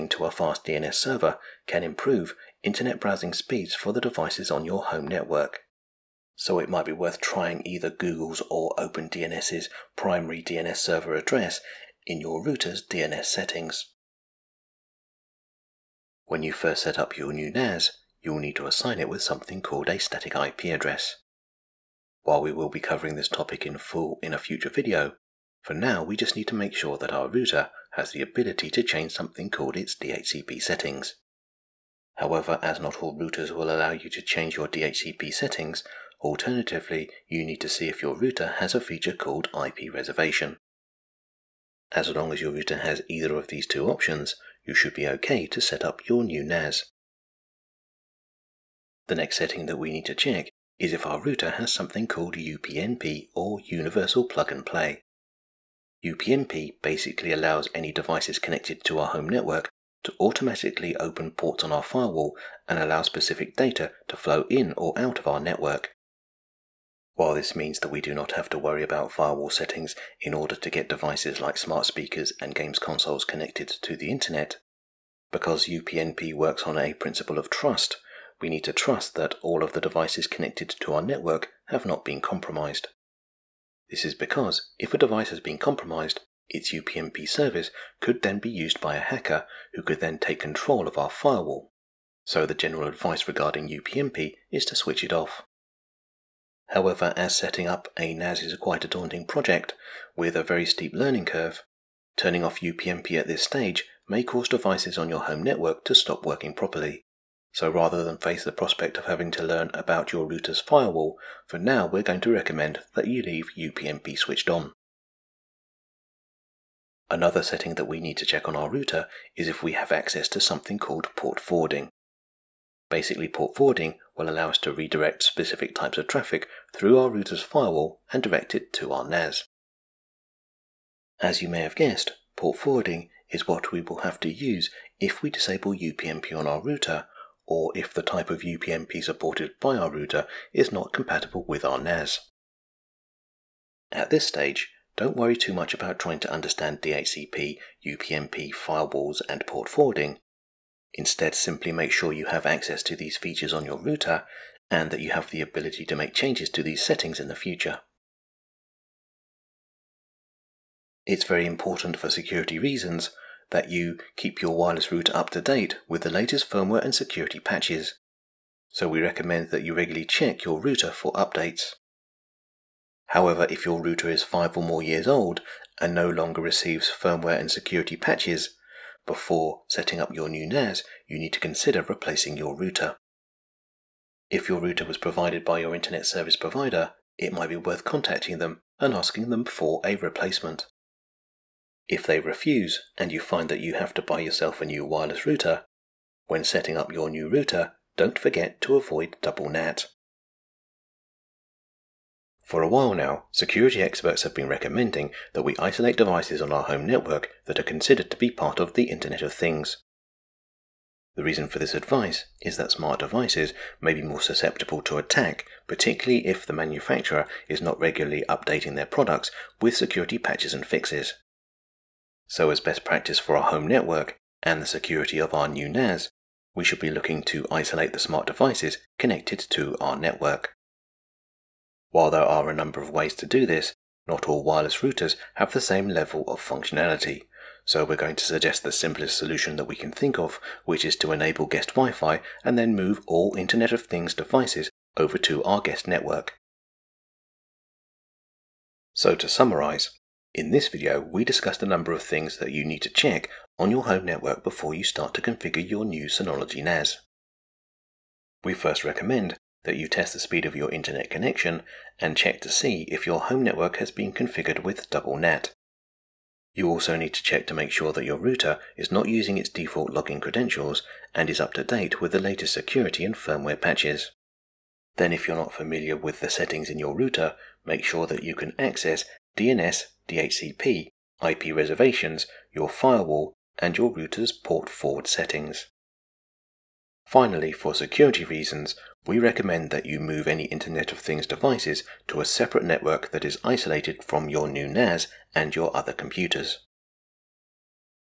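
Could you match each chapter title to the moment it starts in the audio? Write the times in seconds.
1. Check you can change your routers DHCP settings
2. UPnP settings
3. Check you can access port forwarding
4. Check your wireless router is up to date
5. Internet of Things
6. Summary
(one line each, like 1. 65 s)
1. 14 s
2. 46 s
3. 115 s
4. 158 s
5. 200 s
6. 246 s.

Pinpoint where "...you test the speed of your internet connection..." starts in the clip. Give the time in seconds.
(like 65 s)
259 s.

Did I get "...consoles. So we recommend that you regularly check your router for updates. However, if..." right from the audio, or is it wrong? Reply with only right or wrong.
wrong.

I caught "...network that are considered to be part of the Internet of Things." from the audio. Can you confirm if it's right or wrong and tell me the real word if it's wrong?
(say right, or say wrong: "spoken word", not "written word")
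right.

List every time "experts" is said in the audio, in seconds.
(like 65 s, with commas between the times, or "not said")
203 s.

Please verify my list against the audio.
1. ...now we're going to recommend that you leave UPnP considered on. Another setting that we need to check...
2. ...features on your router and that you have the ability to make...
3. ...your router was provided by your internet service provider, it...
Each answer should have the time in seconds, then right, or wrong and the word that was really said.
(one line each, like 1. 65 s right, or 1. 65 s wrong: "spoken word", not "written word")
1. 111 s wrong: "switched", not "considered"
2. 153 s right
3. 184 s right.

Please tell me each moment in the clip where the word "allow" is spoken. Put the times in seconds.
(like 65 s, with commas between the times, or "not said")
33 s, 57 s, 62 s, 124 s.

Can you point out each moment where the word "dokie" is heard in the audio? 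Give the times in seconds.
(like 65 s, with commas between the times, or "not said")
not said.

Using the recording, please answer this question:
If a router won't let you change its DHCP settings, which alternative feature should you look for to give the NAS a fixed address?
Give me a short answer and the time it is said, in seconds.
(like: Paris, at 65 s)
IP reservation, at 39 s.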